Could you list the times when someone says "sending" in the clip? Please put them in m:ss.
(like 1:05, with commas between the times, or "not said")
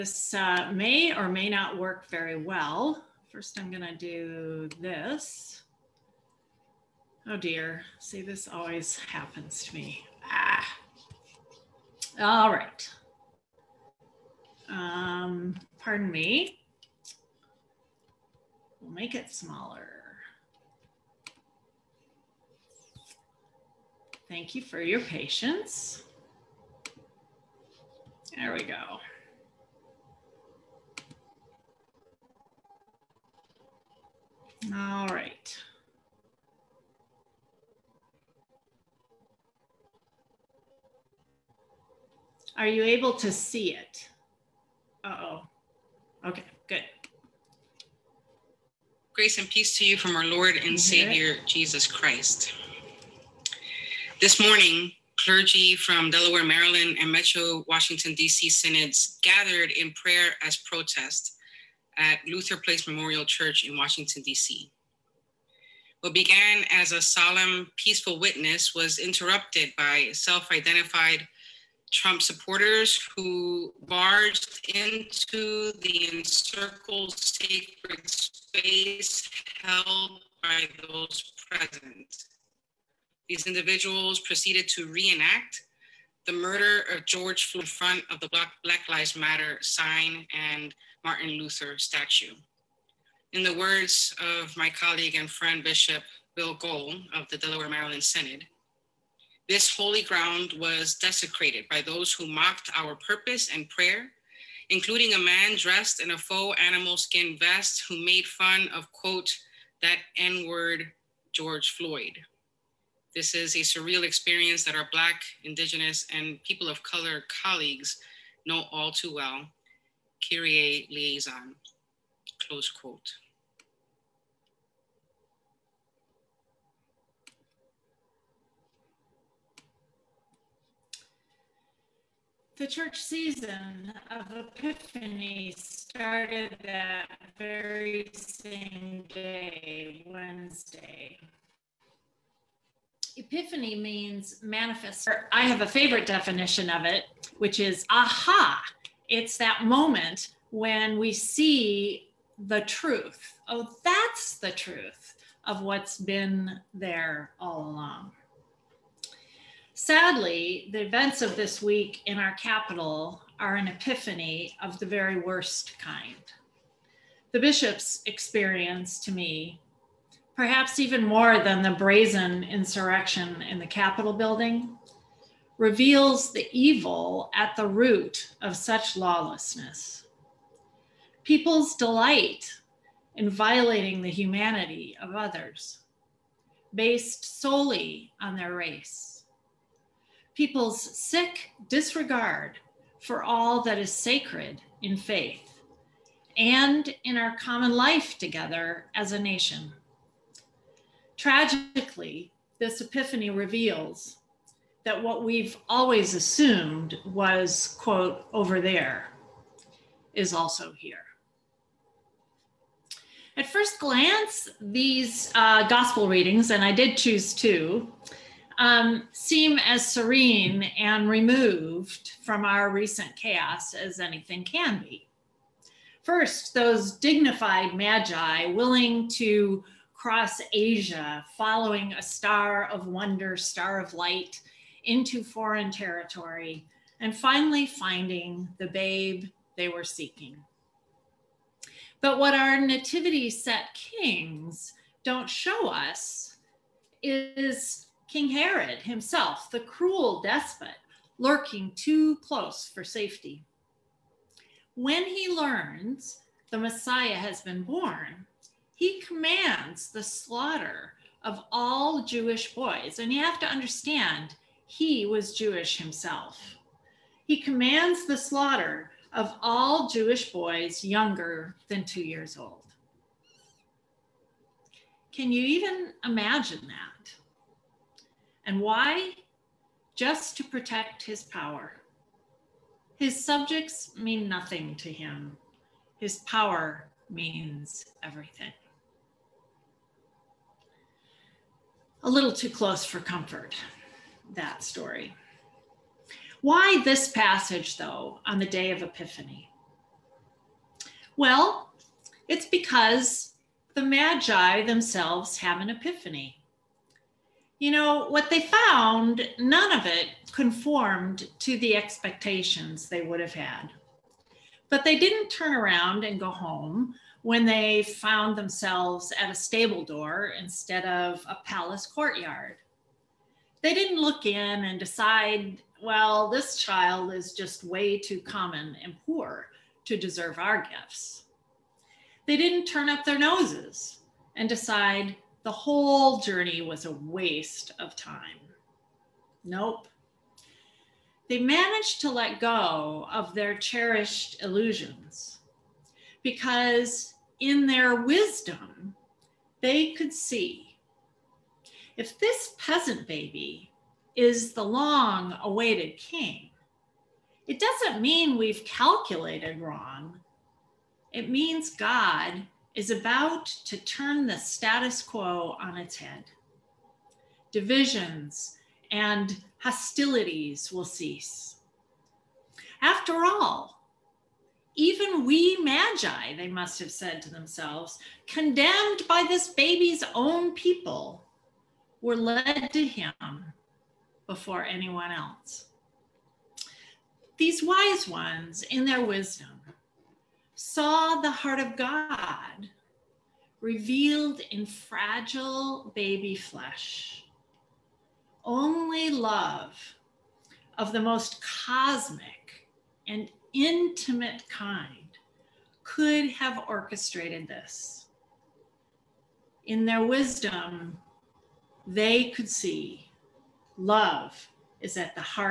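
not said.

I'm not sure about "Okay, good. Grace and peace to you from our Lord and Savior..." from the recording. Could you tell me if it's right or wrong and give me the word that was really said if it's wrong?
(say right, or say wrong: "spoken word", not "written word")
right.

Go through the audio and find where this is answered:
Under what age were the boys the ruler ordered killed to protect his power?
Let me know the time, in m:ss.
4:31.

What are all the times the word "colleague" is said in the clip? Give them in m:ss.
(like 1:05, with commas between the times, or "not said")
1:34, 1:57.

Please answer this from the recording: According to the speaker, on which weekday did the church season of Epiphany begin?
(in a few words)
Wednesday.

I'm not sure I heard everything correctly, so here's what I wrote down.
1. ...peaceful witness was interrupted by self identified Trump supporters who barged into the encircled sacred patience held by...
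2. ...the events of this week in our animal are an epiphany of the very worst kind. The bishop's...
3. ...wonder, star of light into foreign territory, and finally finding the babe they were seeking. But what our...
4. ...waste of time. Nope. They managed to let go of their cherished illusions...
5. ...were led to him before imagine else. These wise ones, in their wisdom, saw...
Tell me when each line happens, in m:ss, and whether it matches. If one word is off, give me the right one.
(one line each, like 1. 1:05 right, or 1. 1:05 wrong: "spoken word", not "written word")
1. 1:07 wrong: "space", not "patience"
2. 2:40 wrong: "capital", not "animal"
3. 3:52 right
4. 5:36 right
5. 6:22 wrong: "anyone", not "imagine".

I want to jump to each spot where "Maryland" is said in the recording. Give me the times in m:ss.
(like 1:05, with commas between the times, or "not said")
0:56, 1:37.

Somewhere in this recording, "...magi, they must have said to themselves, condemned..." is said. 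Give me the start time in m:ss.
6:15.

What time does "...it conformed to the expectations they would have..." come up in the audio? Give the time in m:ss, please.
5:09.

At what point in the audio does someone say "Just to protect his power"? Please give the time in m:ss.
4:39.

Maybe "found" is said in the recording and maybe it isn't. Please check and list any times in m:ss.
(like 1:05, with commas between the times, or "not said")
5:08, 5:17.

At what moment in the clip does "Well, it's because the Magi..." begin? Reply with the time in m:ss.
5:01.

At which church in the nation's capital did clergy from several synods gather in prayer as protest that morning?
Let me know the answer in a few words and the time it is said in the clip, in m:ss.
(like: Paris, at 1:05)
Luther Place Memorial Church, at 1:02.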